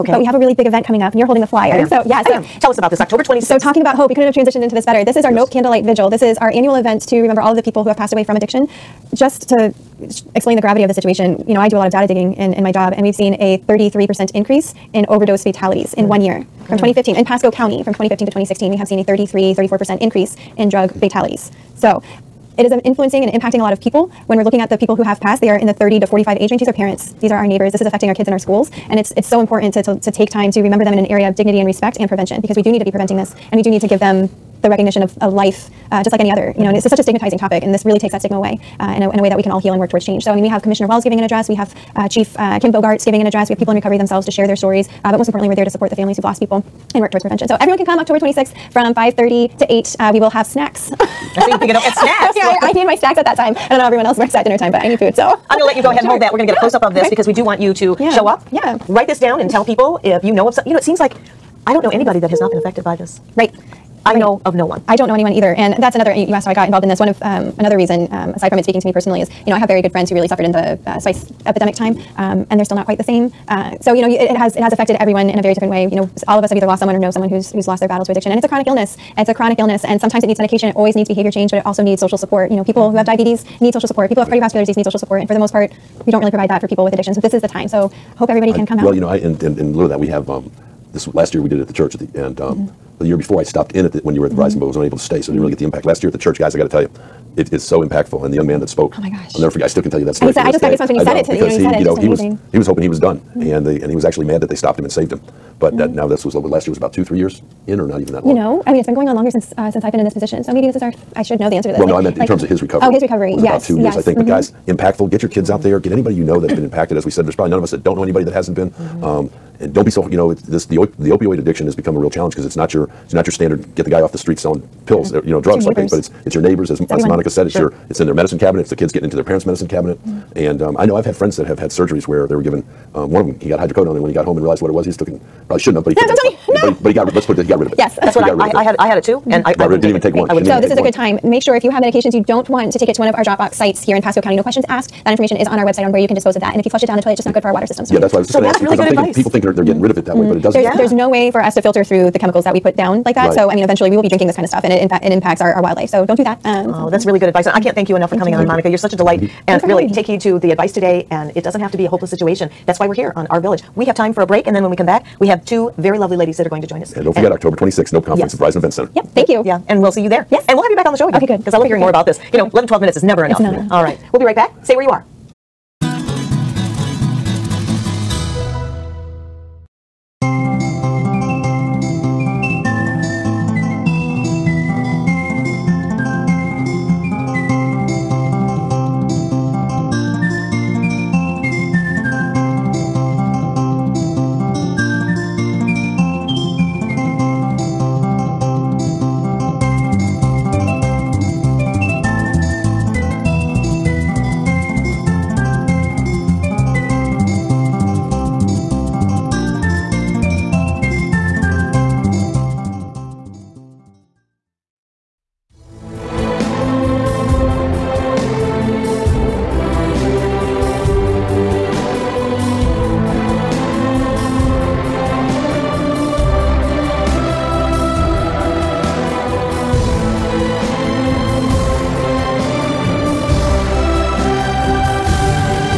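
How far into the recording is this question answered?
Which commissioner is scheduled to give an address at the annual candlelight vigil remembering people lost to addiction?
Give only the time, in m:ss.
0:40.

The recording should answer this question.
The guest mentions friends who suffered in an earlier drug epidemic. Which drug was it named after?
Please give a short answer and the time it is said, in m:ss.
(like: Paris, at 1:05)
Spice, at 1:10.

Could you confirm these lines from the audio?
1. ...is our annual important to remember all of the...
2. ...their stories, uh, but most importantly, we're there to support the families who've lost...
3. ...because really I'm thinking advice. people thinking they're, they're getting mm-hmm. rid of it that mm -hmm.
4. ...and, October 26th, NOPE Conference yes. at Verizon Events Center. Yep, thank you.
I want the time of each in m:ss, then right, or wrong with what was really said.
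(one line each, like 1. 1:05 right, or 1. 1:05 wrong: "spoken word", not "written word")
1. 0:06 wrong: "event", not "important"
2. 0:44 right
3. 2:28 right
4. 2:47 right.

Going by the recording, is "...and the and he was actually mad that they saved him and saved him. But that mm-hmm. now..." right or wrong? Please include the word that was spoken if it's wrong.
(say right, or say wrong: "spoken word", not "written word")
wrong: "stopped", not "saved".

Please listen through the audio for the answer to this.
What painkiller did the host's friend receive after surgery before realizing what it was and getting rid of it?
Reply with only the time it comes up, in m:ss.
2:13.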